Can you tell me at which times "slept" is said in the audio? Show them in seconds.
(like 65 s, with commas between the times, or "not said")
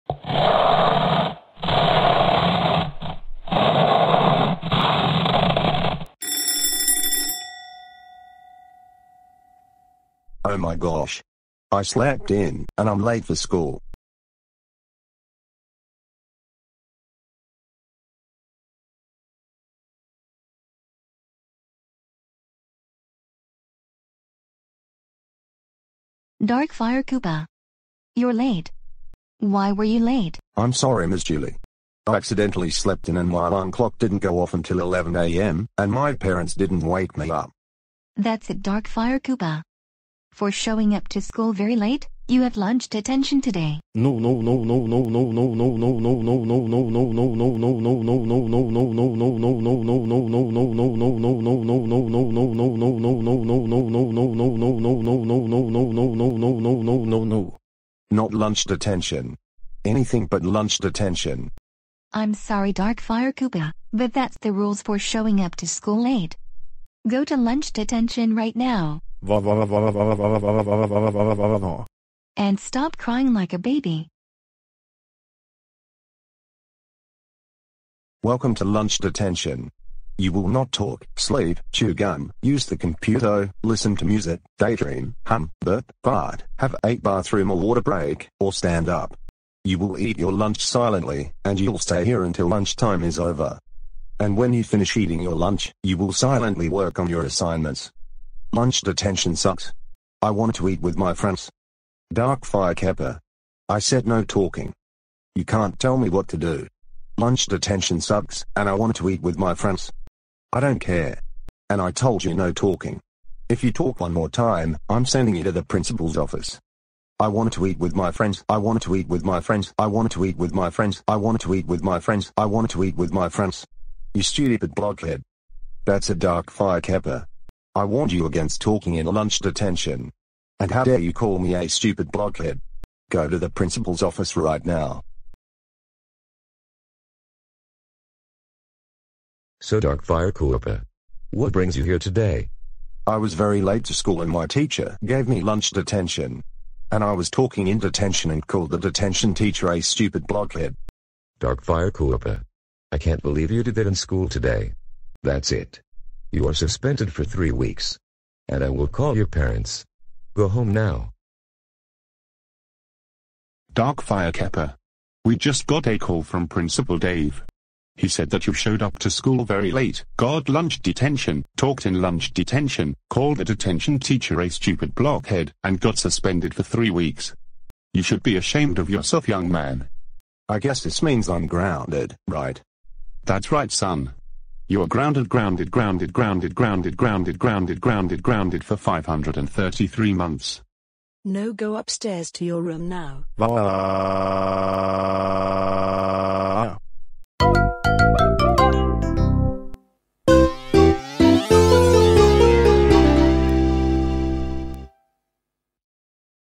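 11 s, 32 s.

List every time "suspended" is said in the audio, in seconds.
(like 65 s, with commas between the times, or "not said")
156 s, 175 s.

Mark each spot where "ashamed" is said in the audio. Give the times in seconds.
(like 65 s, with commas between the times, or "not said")
178 s.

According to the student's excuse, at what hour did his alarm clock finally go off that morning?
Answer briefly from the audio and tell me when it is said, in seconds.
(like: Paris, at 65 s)
11 a.m., at 34 s.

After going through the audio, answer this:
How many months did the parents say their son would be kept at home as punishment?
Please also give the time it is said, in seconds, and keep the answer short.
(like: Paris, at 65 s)
533, at 188 s.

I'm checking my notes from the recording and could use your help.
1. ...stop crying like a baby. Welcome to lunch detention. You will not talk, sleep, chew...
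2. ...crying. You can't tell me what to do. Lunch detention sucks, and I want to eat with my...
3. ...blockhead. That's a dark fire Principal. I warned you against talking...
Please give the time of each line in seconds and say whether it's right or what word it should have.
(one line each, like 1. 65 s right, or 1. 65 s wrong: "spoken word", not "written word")
1. 72 s right
2. 104 s wrong: "talking", not "crying"
3. 124 s wrong: "Koopa", not "Principal".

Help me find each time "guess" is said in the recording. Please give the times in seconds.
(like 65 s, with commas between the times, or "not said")
180 s.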